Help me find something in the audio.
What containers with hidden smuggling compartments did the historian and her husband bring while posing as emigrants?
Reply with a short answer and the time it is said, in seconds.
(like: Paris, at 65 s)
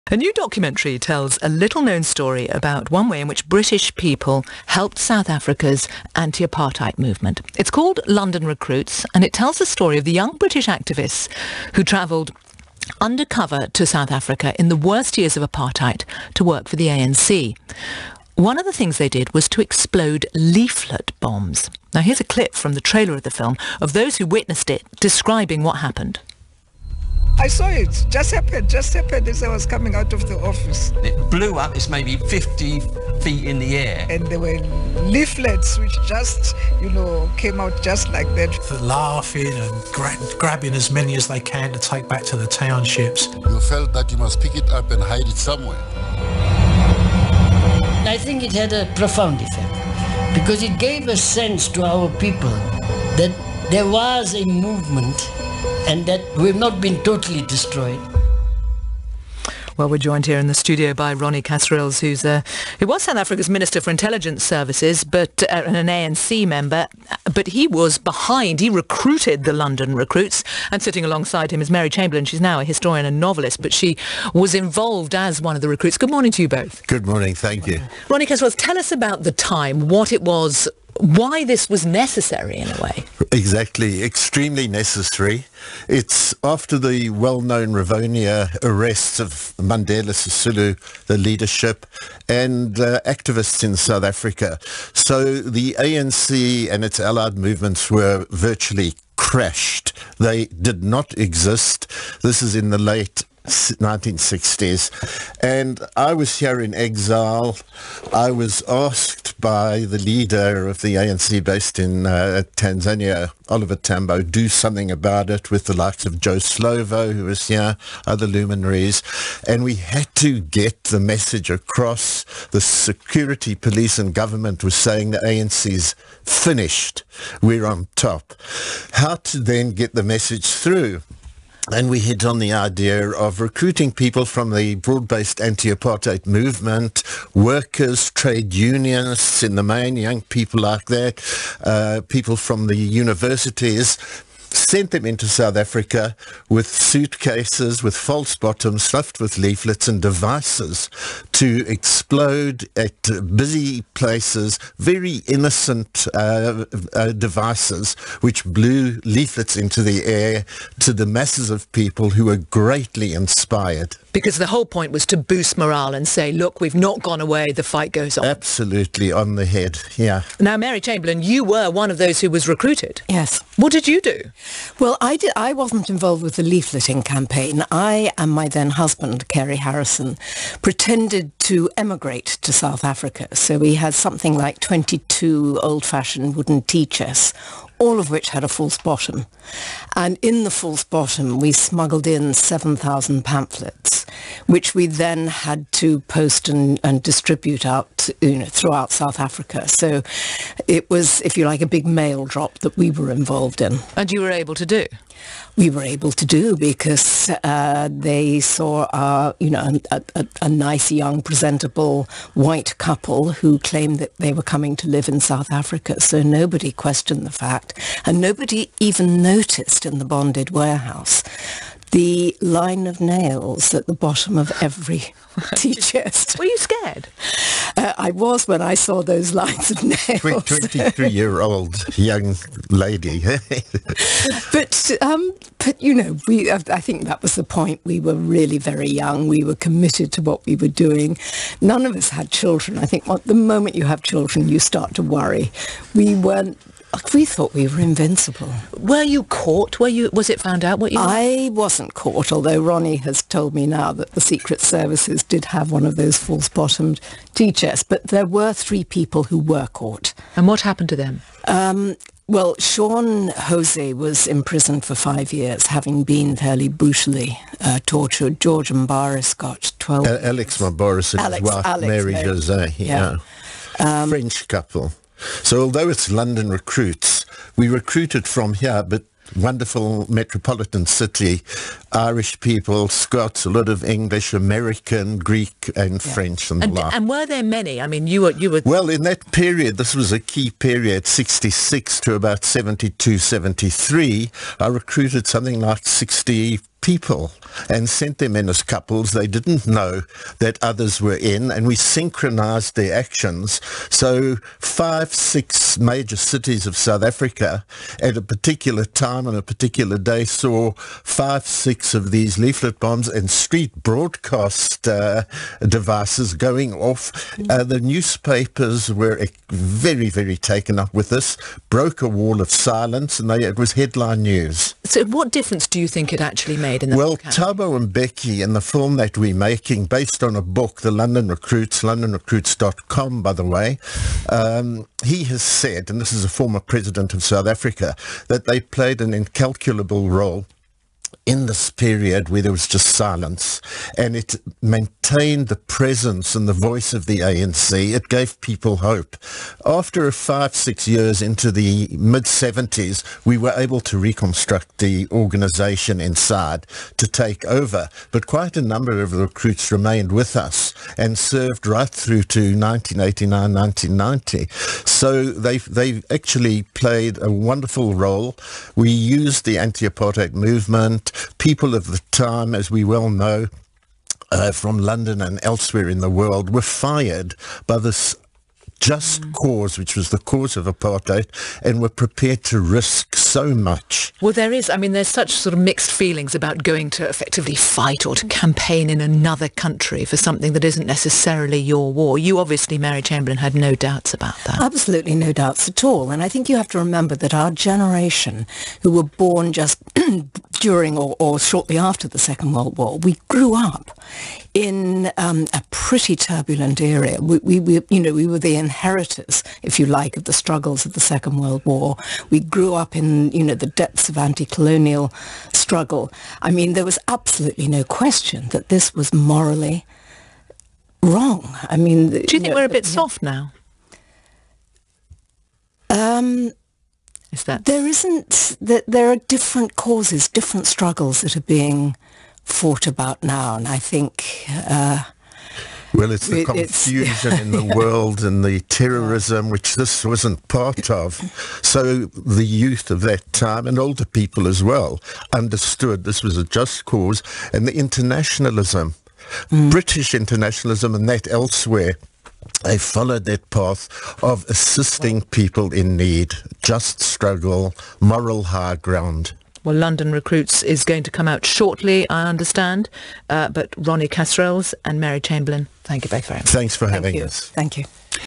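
wooden tea chests, at 186 s.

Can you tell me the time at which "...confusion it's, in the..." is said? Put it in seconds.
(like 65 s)
436 s.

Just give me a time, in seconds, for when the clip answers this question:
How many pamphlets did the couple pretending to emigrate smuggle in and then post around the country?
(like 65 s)
192 s.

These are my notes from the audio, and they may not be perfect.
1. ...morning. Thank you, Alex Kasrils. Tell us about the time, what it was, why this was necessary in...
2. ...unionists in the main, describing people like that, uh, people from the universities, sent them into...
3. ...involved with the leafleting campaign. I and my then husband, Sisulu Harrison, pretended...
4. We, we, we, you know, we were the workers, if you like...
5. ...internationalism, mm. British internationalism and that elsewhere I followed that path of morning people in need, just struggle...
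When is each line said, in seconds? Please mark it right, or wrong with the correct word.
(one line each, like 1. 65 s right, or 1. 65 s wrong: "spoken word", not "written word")
1. 77 s wrong: "Ronnie", not "Alex"
2. 138 s wrong: "young", not "describing"
3. 175 s wrong: "Kerry", not "Sisulu"
4. 407 s wrong: "inheritors", not "workers"
5. 447 s wrong: "assisting", not "morning".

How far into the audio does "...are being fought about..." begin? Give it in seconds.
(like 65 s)
431 s.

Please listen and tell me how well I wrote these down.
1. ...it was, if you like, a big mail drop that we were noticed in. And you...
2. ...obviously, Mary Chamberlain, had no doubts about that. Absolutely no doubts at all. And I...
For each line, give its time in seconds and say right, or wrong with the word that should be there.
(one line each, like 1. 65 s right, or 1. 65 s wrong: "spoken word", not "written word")
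1. 200 s wrong: "involved", not "noticed"
2. 392 s right.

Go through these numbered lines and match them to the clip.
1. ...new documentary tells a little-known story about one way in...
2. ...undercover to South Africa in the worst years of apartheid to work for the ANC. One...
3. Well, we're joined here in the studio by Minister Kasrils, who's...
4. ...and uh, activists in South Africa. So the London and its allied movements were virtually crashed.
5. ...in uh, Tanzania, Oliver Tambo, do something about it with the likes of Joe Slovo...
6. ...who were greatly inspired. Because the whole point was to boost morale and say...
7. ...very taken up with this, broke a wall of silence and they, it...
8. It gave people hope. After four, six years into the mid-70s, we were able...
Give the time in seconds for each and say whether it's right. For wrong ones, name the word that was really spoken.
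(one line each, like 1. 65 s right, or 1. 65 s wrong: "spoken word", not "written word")
1. 0 s right
2. 12 s right
3. 59 s wrong: "Ronnie", not "Minister"
4. 92 s wrong: "ANC", not "London"
5. 111 s right
6. 162 s right
7. 320 s right
8. 347 s wrong: "five", not "four".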